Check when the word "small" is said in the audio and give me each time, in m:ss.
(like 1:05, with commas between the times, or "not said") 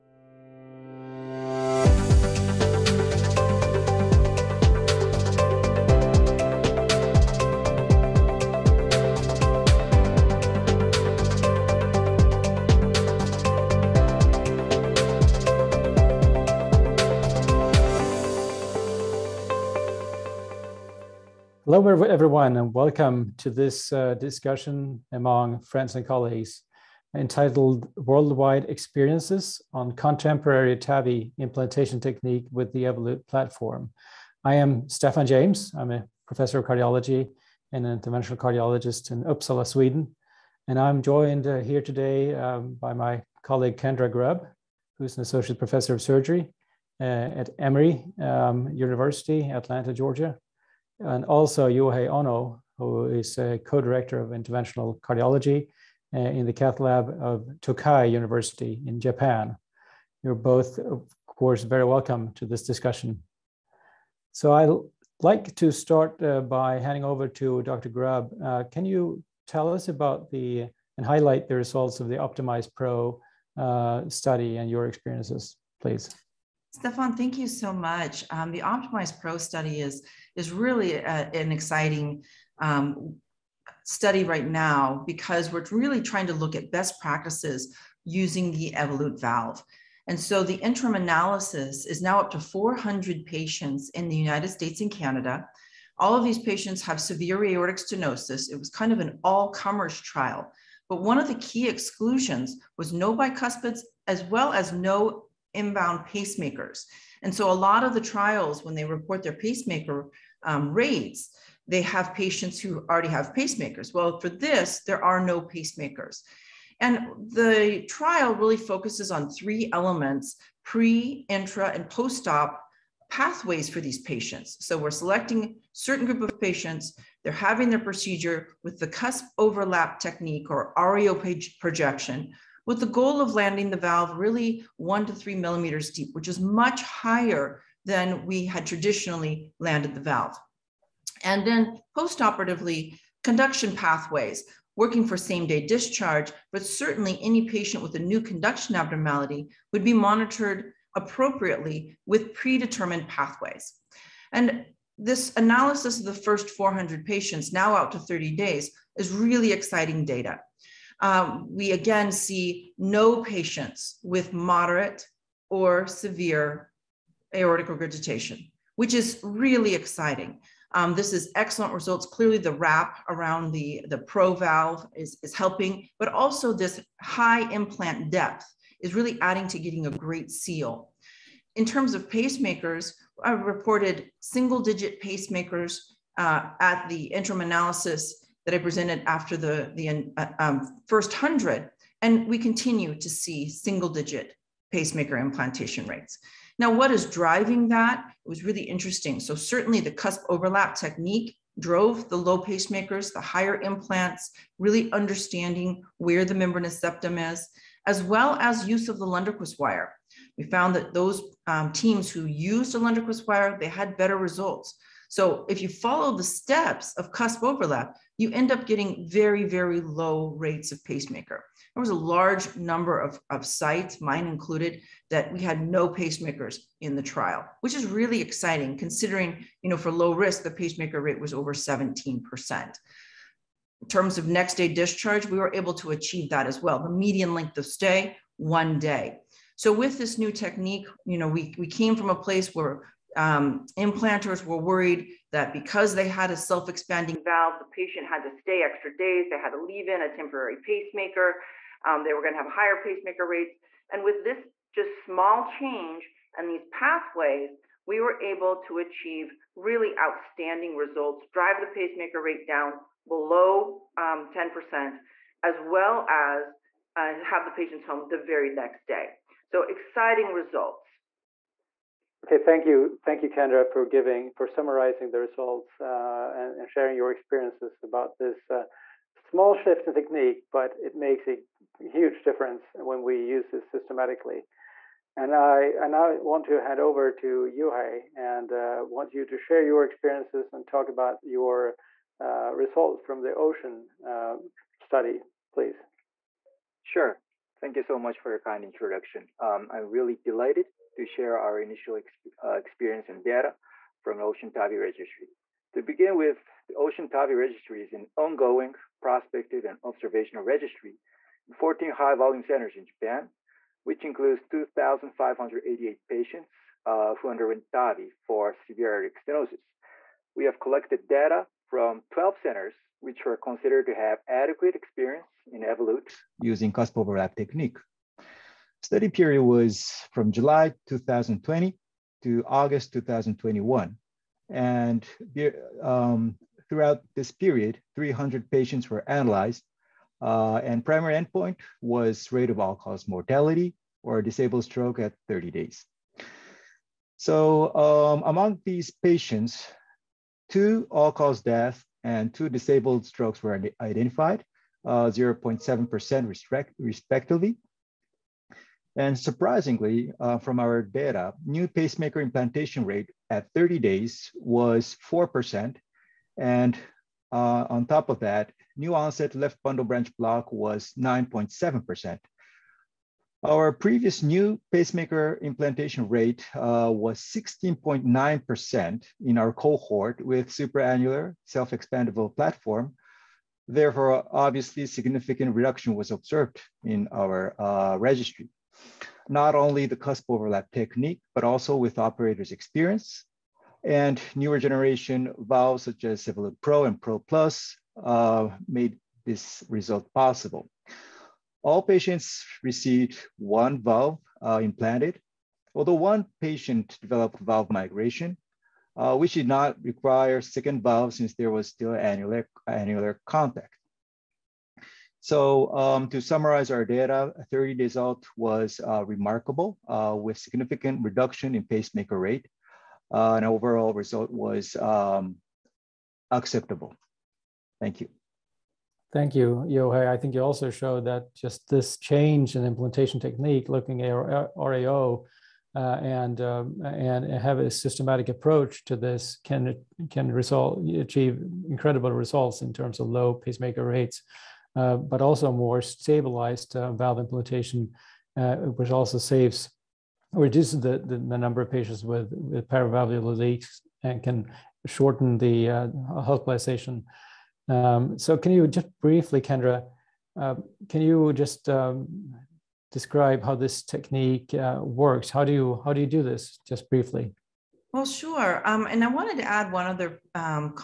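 4:15, 4:39.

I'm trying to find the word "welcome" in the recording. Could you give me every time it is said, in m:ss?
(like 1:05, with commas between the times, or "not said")
0:22, 1:01.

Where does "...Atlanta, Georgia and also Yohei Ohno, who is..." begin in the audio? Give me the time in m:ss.
0:49.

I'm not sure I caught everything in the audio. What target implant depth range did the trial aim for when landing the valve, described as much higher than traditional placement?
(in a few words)
1 to 3 millimeters.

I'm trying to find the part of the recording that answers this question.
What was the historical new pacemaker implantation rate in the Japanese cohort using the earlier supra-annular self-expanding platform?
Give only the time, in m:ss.
6:17.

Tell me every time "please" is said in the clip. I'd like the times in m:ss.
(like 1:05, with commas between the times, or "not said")
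1:15, 4:55.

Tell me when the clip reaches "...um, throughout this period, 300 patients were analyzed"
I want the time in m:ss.
5:35.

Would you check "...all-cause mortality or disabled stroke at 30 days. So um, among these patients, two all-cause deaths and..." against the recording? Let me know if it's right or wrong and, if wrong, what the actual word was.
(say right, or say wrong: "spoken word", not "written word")
right.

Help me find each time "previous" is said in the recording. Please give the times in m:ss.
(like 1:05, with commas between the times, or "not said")
6:13.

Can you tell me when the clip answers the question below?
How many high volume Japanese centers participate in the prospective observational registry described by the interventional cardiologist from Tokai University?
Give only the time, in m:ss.
5:11.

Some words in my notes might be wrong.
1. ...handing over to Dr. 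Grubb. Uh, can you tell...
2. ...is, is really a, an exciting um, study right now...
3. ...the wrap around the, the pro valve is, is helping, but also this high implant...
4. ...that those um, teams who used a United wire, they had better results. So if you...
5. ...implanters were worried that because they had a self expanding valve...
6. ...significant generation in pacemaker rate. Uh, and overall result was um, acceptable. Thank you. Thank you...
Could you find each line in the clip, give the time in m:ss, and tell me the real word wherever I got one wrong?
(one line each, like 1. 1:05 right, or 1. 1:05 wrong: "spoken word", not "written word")
1. 1:06 right
2. 1:19 right
3. 2:52 right
4. 3:30 wrong: "Lunderquist", not "United"
5. 4:03 right
6. 7:00 wrong: "reduction", not "generation".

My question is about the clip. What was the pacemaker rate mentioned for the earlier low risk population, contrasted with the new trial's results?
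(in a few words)
over 17%.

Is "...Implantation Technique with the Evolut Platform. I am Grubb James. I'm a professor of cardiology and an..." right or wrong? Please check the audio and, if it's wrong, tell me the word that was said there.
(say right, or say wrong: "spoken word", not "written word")
wrong: "Stefan", not "Grubb".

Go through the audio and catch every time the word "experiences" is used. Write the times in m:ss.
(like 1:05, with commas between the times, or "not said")
0:28, 1:14, 4:37, 4:49, 5:02, 5:24, 6:32.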